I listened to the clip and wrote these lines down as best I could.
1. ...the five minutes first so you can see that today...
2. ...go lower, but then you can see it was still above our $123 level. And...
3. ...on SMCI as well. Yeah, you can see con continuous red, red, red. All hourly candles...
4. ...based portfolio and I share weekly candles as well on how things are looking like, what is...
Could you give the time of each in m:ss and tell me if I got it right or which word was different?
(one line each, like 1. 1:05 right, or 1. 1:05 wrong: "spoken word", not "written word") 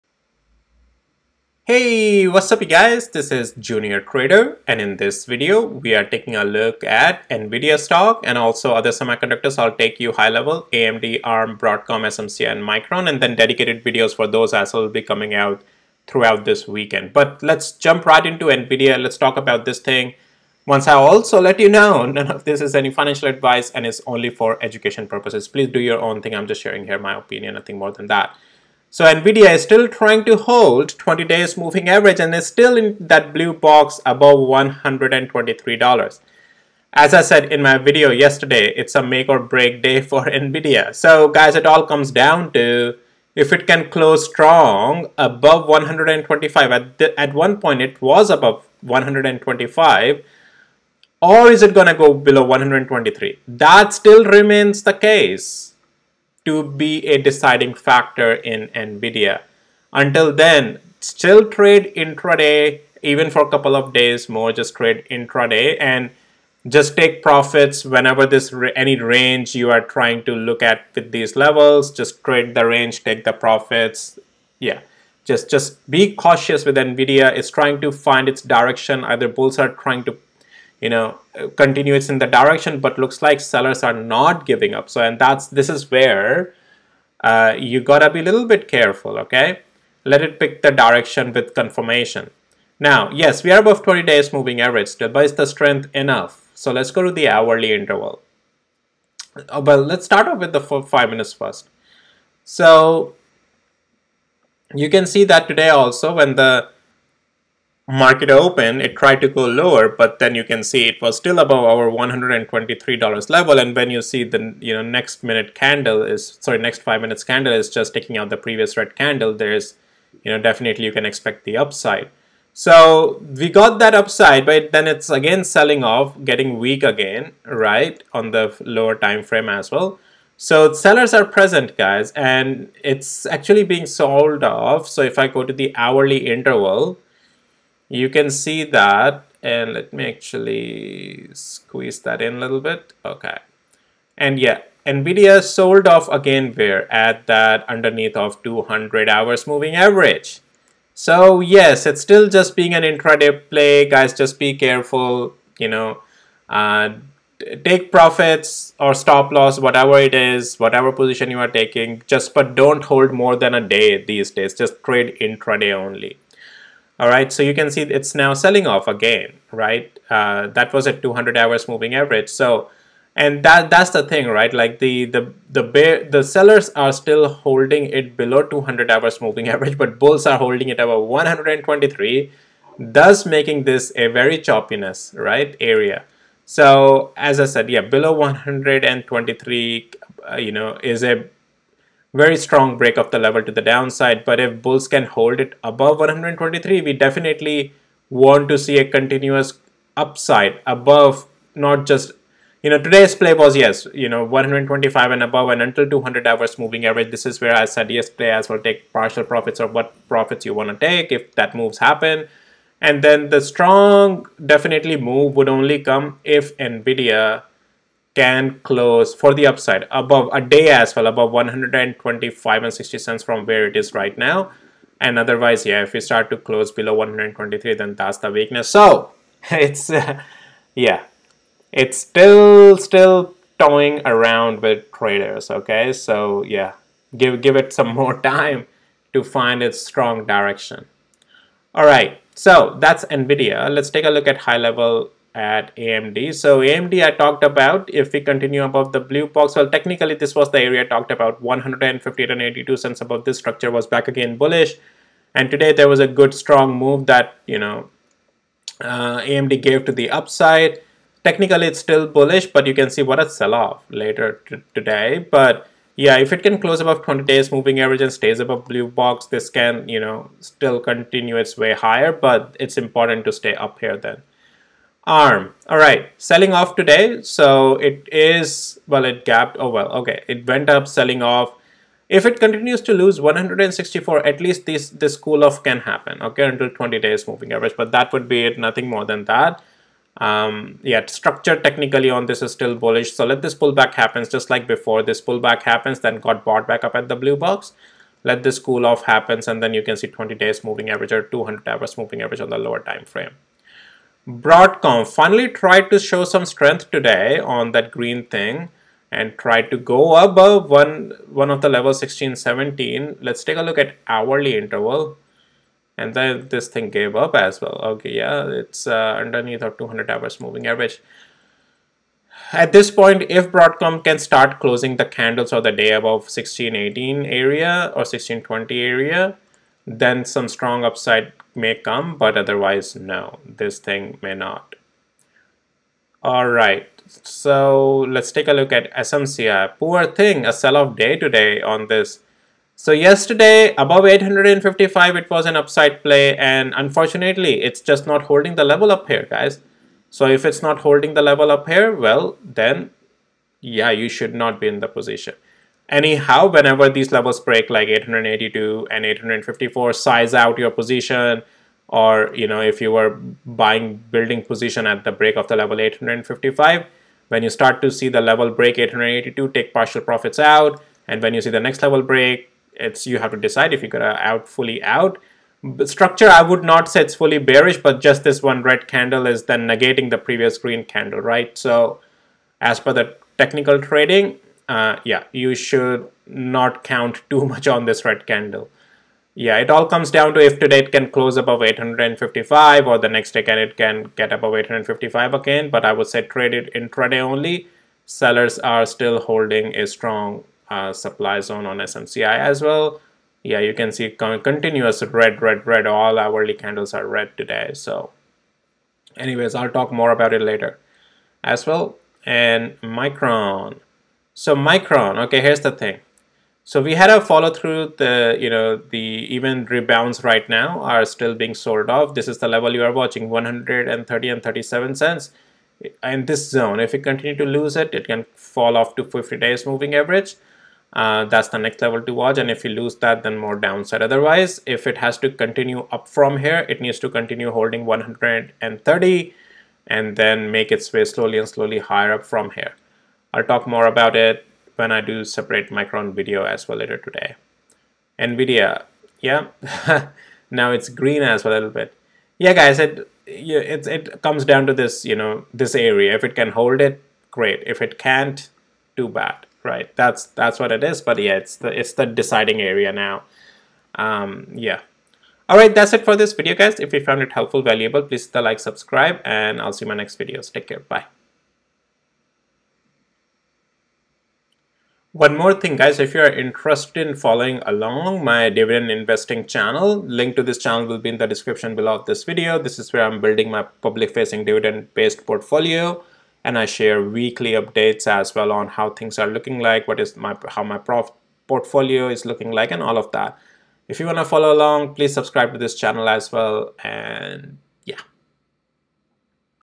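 1. 1:40 right
2. 1:49 right
3. 6:41 right
4. 8:04 wrong: "updates", not "candles".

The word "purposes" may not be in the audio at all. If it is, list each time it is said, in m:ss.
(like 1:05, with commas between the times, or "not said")
0:25.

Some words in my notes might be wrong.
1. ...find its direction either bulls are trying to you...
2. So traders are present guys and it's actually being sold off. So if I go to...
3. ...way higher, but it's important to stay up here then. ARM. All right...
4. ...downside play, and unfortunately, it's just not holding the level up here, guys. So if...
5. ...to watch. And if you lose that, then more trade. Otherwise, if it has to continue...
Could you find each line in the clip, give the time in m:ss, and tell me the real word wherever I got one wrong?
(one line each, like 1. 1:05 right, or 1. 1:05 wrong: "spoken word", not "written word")
1. 1:17 right
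2. 2:10 wrong: "sellers", not "traders"
3. 4:31 right
4. 5:45 wrong: "upside", not "downside"
5. 7:12 wrong: "downside", not "trade".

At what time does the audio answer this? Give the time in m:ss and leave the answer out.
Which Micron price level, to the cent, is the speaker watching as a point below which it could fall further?
7:03.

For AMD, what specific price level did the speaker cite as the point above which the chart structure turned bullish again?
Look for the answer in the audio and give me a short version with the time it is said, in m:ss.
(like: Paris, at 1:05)
$158.82, at 4:11.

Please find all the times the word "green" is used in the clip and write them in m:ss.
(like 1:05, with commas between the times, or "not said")
5:07, 6:20, 7:30.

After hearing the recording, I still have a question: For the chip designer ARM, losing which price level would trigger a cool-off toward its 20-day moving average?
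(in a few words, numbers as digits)
164.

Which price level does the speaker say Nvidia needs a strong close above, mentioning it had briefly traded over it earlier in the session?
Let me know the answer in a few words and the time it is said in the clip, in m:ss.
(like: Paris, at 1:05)
125, at 0:43.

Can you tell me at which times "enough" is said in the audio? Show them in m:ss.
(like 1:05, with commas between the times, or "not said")
1:35.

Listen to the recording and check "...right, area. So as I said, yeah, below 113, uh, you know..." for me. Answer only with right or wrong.
wrong.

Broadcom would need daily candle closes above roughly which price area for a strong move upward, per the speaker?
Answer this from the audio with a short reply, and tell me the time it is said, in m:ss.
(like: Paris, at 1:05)
1620, at 5:28.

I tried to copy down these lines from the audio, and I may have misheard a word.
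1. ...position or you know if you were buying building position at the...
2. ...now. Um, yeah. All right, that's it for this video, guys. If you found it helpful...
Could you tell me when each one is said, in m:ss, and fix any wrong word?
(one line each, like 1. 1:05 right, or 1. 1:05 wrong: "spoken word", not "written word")
1. 6:00 right
2. 7:42 right.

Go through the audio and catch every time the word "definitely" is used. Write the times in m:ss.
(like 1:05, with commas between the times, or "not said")
2:00, 3:16, 3:34.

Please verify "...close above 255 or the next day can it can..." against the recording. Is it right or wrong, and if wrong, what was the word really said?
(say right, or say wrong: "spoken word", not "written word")
wrong: "855", not "255".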